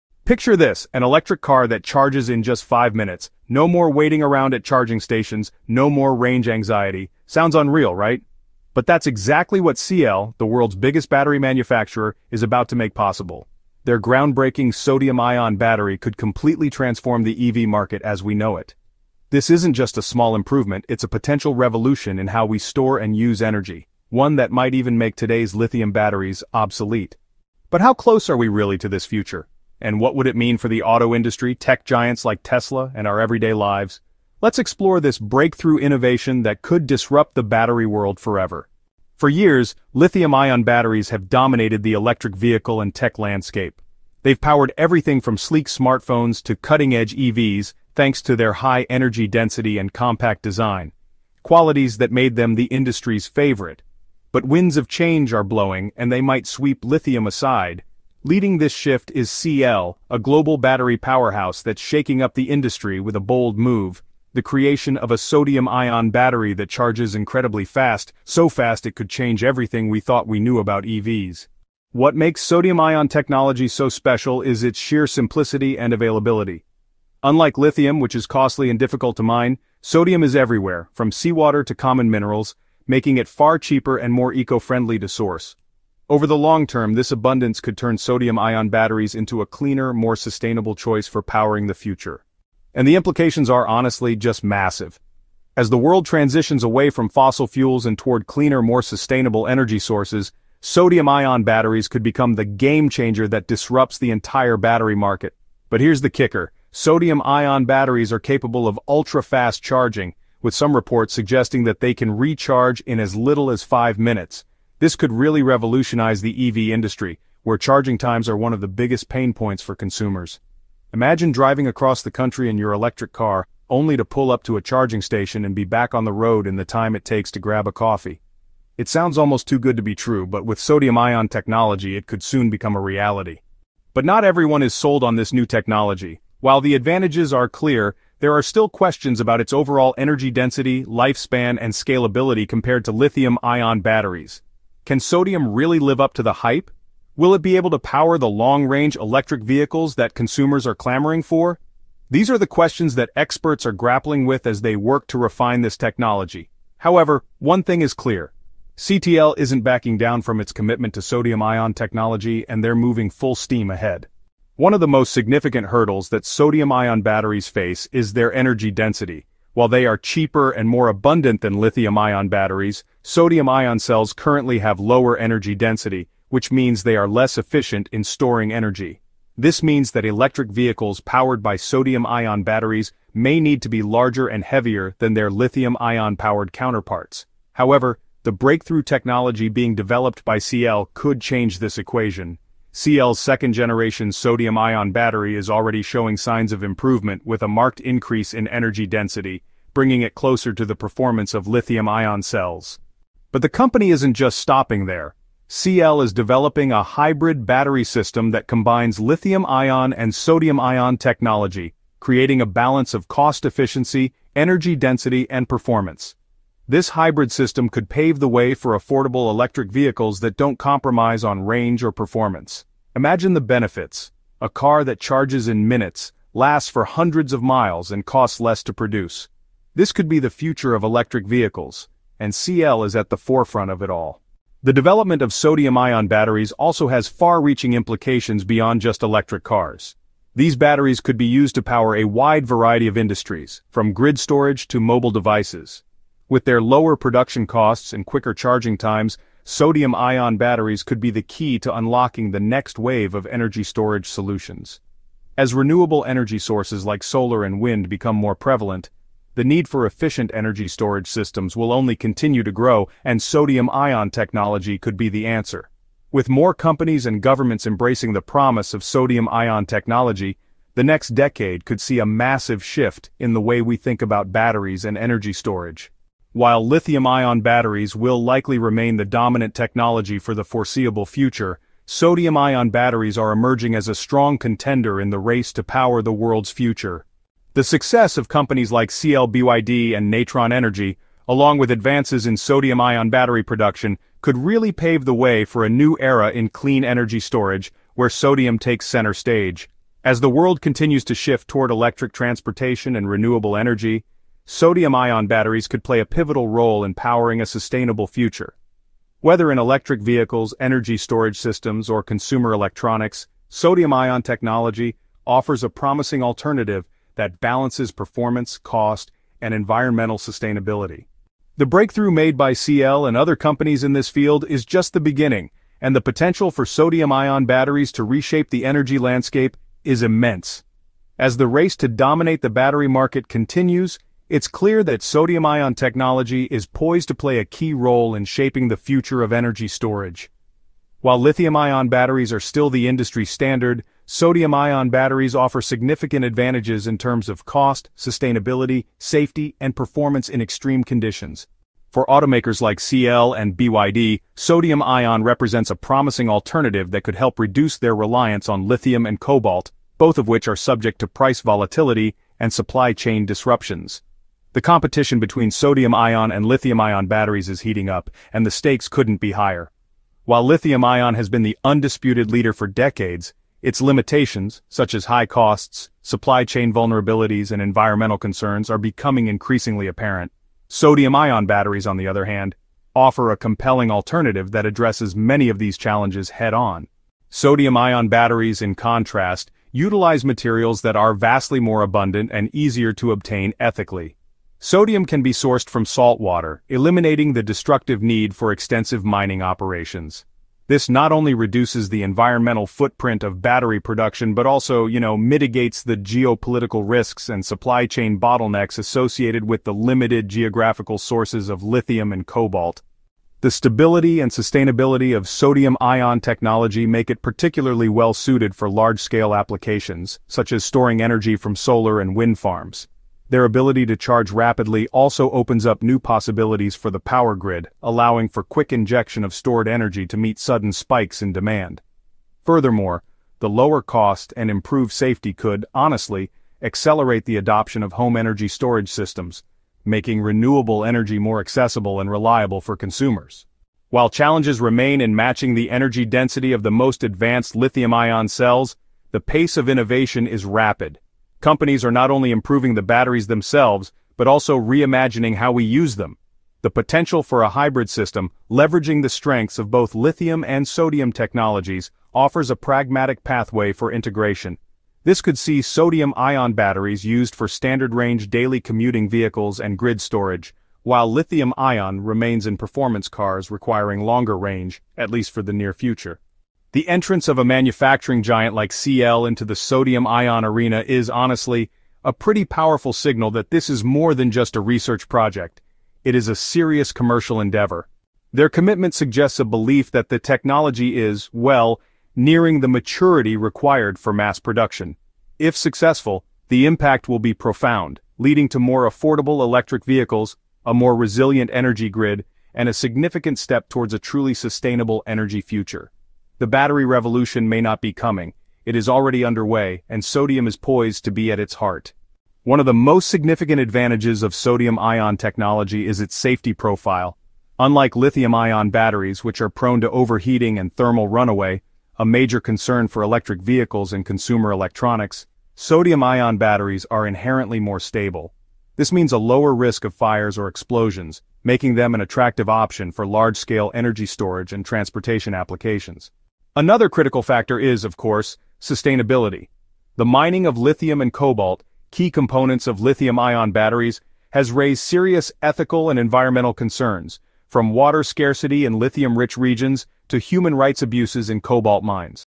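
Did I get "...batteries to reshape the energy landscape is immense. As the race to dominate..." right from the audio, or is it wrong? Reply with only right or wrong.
right.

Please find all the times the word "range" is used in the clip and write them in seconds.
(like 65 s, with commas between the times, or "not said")
6 s, 148 s, 221 s, 467 s, 474 s.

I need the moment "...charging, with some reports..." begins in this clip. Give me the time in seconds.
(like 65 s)
109 s.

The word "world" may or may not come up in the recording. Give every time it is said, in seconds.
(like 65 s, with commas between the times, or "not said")
10 s, 37 s, 95 s, 286 s, 300 s.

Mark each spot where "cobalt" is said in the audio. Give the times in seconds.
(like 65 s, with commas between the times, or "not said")
359 s, 412 s, 541 s, 551 s.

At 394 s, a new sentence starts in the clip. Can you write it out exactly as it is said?
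Sodium can be sourced from salt water, eliminating the destructive need for extensive mining operations.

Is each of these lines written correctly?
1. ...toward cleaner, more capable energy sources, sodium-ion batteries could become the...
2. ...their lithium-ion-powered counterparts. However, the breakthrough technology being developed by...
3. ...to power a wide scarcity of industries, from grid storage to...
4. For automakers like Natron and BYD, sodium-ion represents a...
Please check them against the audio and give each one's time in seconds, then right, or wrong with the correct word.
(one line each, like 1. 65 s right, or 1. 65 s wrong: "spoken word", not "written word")
1. 97 s wrong: "sustainable", not "capable"
2. 185 s right
3. 241 s wrong: "variety", not "scarcity"
4. 351 s wrong: "CATL", not "Natron".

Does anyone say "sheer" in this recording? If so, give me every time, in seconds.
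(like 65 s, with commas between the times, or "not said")
74 s.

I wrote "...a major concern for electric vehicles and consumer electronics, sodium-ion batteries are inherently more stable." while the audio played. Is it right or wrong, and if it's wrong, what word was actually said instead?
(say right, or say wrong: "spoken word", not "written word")
right.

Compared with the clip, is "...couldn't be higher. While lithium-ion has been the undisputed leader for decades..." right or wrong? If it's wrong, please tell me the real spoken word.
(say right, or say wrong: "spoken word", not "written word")
right.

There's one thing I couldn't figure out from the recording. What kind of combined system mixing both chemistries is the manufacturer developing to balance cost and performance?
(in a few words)
hybrid battery system.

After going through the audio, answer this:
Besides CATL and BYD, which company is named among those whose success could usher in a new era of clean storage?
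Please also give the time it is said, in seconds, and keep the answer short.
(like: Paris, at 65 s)
Natron Energy, at 290 s.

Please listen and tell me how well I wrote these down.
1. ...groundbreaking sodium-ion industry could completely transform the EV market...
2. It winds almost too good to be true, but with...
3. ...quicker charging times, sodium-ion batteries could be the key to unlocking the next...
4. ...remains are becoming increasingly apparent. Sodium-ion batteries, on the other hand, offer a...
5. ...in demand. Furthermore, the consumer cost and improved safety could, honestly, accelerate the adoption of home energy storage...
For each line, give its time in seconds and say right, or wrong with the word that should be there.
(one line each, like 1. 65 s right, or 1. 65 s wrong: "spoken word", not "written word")
1. 13 s wrong: "battery", not "industry"
2. 128 s wrong: "sounds", not "winds"
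3. 248 s right
4. 378 s wrong: "concerns", not "remains"
5. 431 s wrong: "lower", not "consumer".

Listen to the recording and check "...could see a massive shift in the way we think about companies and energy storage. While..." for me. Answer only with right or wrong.
wrong.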